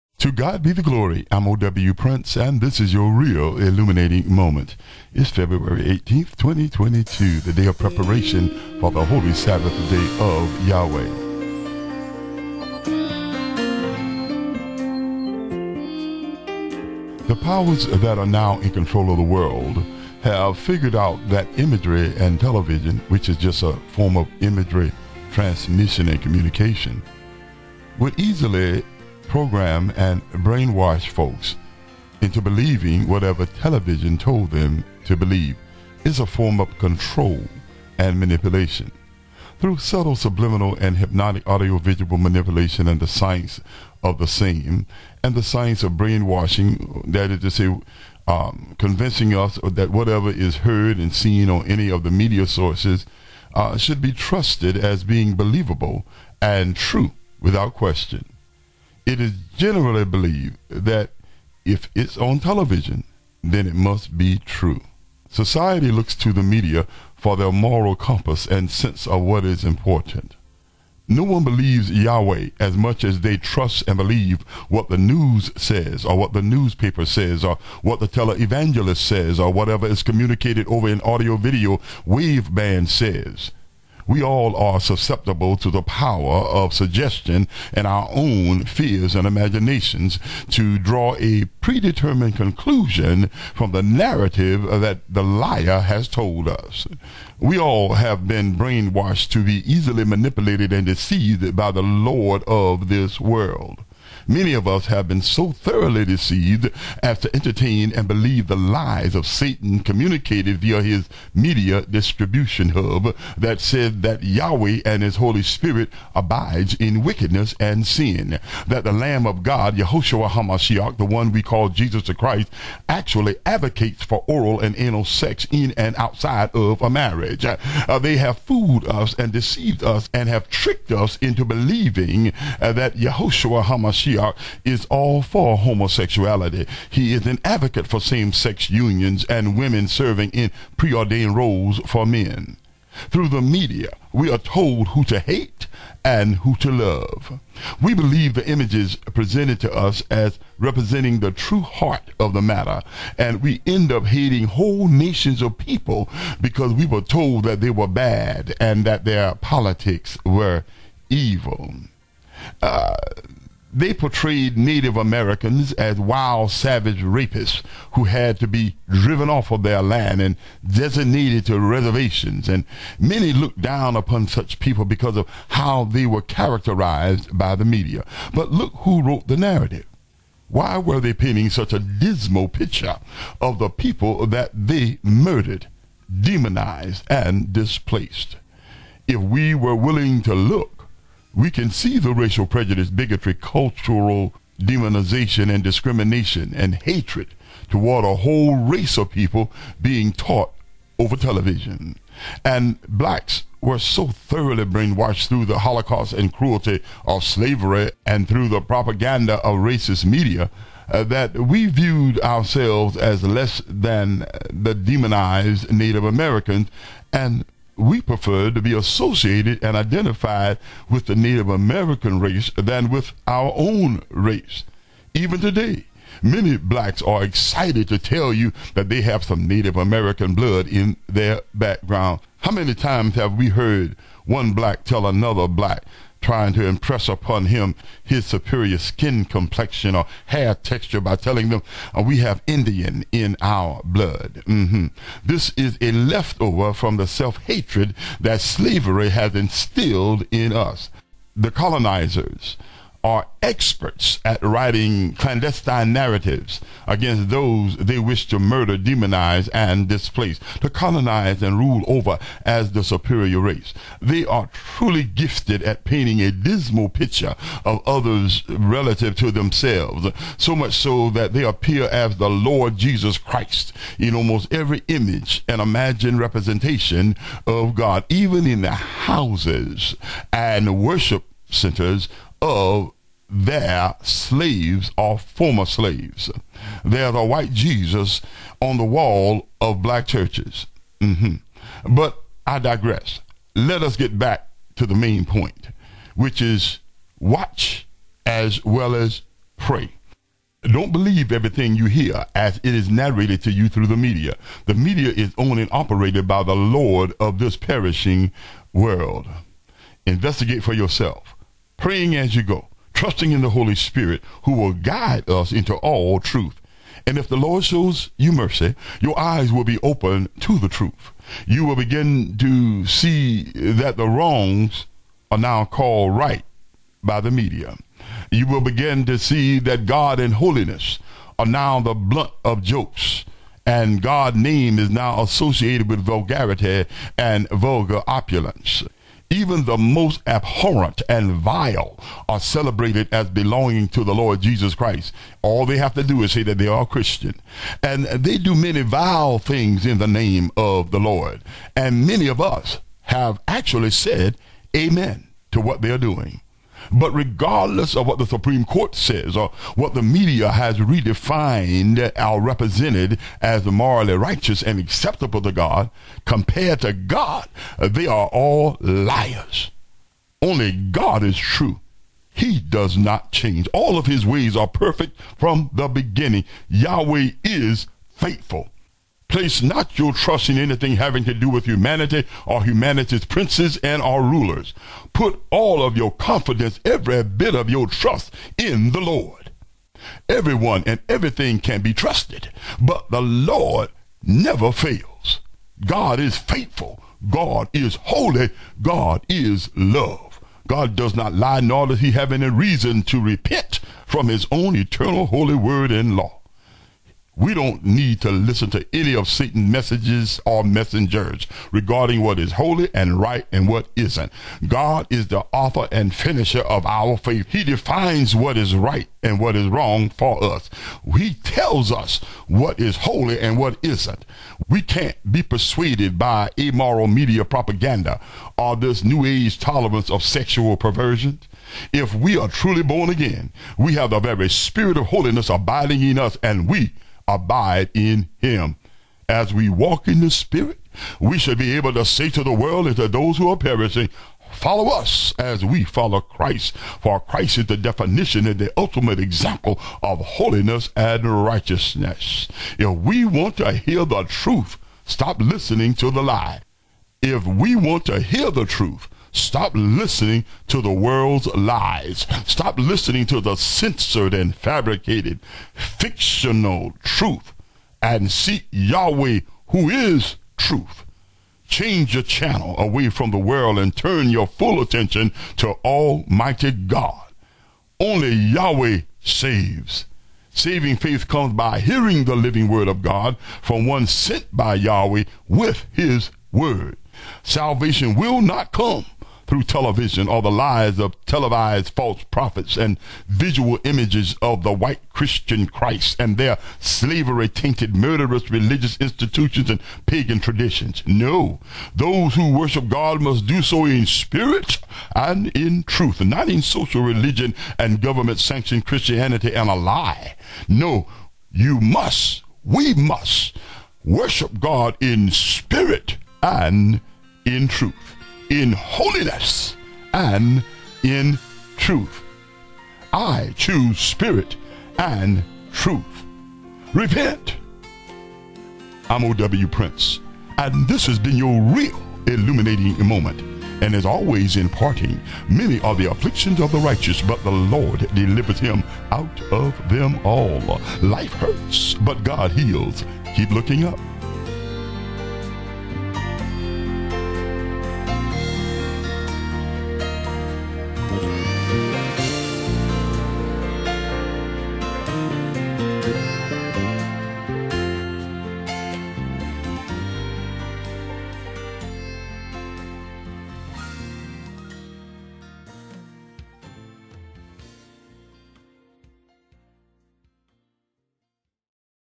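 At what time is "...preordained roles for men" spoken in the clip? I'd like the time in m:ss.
2:20.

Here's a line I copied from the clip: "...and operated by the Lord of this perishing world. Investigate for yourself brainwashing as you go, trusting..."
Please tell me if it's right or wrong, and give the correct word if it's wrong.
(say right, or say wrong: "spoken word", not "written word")
wrong: "praying", not "brainwashing".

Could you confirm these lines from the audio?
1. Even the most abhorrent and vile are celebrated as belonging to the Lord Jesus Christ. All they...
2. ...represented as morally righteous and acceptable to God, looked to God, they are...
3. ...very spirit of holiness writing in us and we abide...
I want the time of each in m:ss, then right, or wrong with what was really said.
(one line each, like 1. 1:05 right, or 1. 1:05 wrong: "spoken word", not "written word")
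1. 5:39 right
2. 6:02 wrong: "compared", not "looked"
3. 7:14 wrong: "abiding", not "writing".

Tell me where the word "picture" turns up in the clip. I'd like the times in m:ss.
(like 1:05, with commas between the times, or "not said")
3:02, 4:26.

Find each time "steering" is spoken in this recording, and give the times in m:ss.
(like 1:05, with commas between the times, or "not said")
not said.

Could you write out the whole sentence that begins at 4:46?
There's a white Jesus on the wall of black churches.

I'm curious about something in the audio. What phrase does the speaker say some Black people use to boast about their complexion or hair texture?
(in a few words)
we have Indian in our blood.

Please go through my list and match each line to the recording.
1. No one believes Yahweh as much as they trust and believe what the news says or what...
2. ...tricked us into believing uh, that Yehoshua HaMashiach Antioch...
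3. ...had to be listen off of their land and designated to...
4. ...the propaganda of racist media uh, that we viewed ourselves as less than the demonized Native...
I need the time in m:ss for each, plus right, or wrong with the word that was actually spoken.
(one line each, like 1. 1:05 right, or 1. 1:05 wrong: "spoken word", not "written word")
1. 1:11 right
2. 2:10 right
3. 2:48 wrong: "driven", not "listen"
4. 3:28 right.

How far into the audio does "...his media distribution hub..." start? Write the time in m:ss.
1:50.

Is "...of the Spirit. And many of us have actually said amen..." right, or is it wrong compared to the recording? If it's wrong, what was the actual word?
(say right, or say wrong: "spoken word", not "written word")
wrong: "Lord", not "Spirit".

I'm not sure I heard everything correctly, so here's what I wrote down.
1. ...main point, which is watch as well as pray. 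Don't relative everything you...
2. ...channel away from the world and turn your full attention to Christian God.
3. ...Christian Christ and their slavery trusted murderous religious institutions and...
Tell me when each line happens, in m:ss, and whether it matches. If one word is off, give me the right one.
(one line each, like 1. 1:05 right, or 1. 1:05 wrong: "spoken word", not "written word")
1. 4:54 wrong: "believe", not "relative"
2. 7:52 wrong: "Almighty", not "Christian"
3. 8:15 wrong: "tainted", not "trusted".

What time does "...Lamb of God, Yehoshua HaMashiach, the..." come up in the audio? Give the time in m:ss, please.
1:58.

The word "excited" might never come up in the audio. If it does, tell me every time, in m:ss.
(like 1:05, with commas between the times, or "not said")
3:47.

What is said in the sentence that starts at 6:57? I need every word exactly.
He defines what is right and what is wrong for us.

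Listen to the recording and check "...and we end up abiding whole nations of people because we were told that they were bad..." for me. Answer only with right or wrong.
wrong.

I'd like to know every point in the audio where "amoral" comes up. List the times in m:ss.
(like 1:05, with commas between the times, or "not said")
7:06.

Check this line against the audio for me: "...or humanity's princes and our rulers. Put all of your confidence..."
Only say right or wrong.
right.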